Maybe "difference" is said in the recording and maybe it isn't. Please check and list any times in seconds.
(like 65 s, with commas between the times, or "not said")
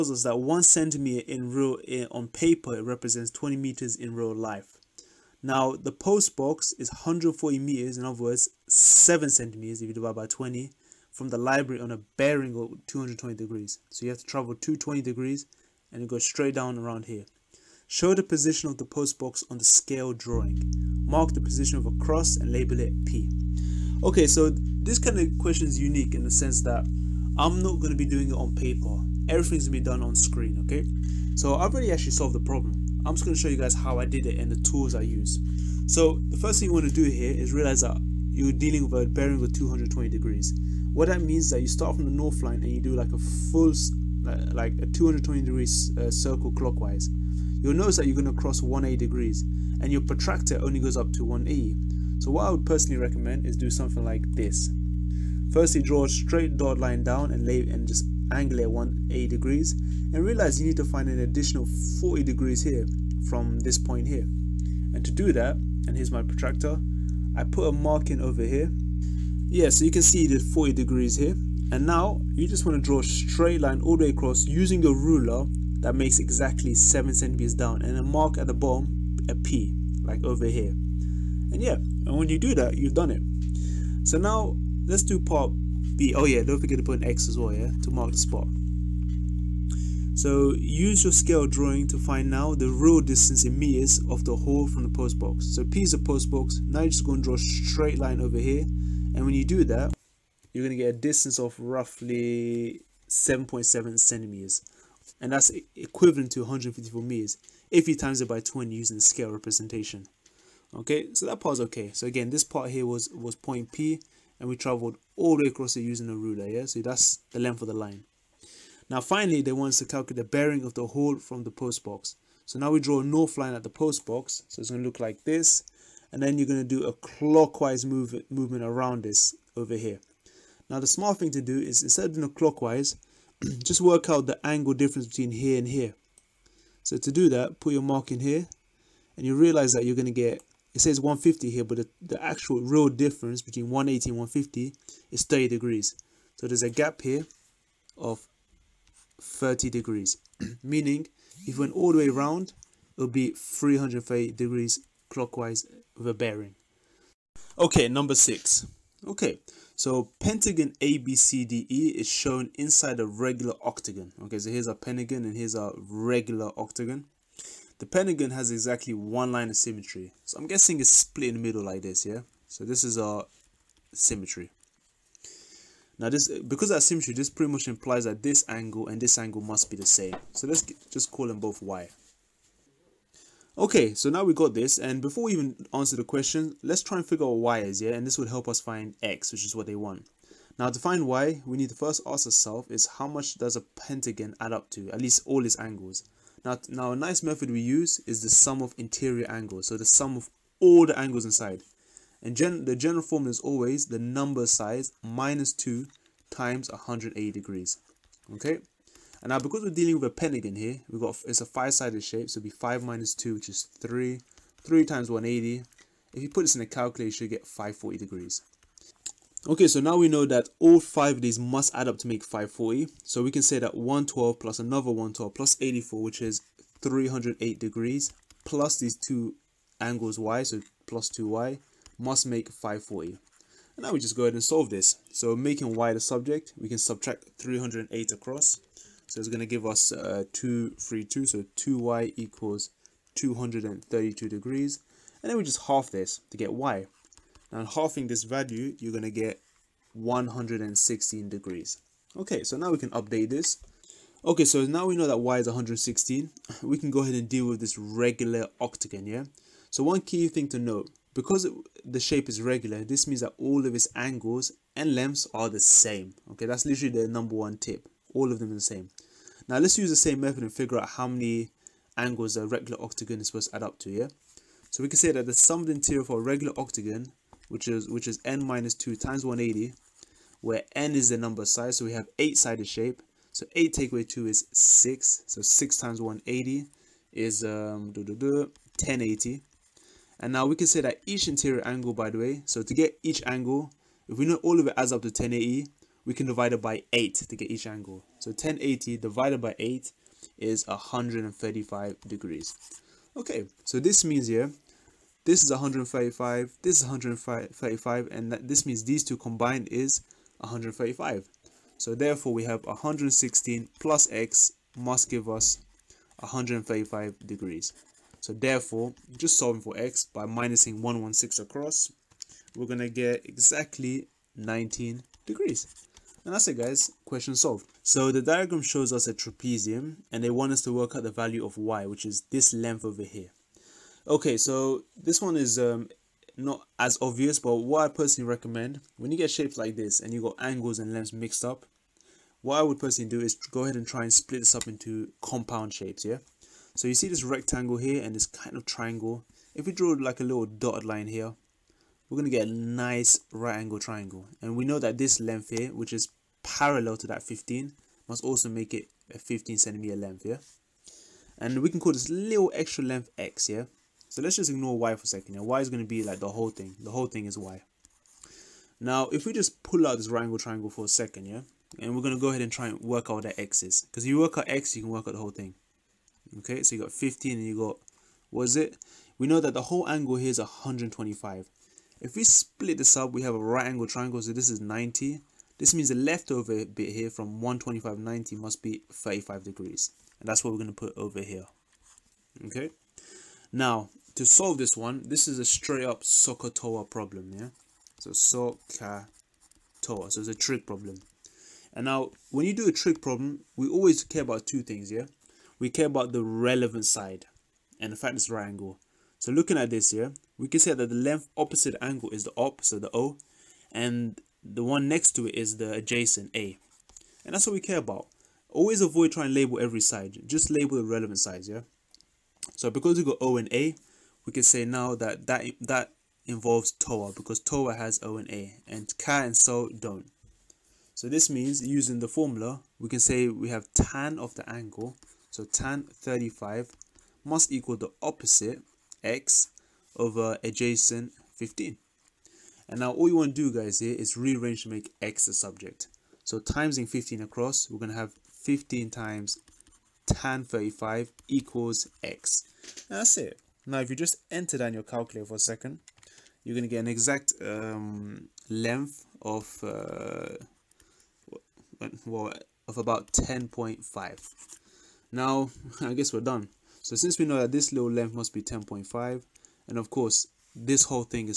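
134 s, 142 s.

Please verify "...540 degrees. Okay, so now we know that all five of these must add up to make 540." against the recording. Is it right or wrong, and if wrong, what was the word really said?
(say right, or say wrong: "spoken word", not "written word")
right.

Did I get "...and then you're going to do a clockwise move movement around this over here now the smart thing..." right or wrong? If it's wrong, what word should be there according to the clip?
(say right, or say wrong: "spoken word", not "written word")
right.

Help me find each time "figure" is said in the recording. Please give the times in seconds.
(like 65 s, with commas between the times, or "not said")
187 s, 270 s.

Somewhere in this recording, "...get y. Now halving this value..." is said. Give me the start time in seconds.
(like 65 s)
246 s.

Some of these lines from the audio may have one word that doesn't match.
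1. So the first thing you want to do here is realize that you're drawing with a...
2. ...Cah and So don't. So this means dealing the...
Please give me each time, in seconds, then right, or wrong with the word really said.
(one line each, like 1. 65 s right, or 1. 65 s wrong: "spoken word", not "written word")
1. 35 s wrong: "dealing", not "drawing"
2. 428 s wrong: "using", not "dealing".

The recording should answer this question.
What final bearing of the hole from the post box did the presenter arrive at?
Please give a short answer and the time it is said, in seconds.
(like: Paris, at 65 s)
330 degrees, at 153 s.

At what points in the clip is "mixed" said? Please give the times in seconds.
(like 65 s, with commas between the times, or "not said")
341 s.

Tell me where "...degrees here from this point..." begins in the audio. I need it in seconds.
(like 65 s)
62 s.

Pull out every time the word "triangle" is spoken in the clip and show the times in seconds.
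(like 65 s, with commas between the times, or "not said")
348 s, 353 s, 370 s, 383 s.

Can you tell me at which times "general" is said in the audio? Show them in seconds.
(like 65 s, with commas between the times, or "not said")
202 s.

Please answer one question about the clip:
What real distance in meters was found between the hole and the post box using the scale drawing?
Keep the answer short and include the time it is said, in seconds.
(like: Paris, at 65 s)
154 meters, at 106 s.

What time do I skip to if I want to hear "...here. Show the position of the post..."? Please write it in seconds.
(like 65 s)
17 s.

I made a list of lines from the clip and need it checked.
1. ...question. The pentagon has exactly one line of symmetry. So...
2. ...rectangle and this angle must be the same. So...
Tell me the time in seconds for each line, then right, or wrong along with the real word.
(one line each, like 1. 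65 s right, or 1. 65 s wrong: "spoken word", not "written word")
1. 166 s wrong: "octagon", not "question"
2. 178 s wrong: "angle", not "rectangle".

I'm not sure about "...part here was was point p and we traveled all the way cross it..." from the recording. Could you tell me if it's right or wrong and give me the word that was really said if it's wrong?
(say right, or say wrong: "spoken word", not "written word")
wrong: "across", not "cross".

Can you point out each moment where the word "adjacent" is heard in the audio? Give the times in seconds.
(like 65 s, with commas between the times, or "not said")
415 s, 440 s.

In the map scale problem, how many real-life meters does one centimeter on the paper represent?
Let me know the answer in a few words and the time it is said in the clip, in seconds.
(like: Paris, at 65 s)
20 meters, at 3 s.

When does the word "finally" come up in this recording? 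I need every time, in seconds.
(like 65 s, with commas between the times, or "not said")
119 s.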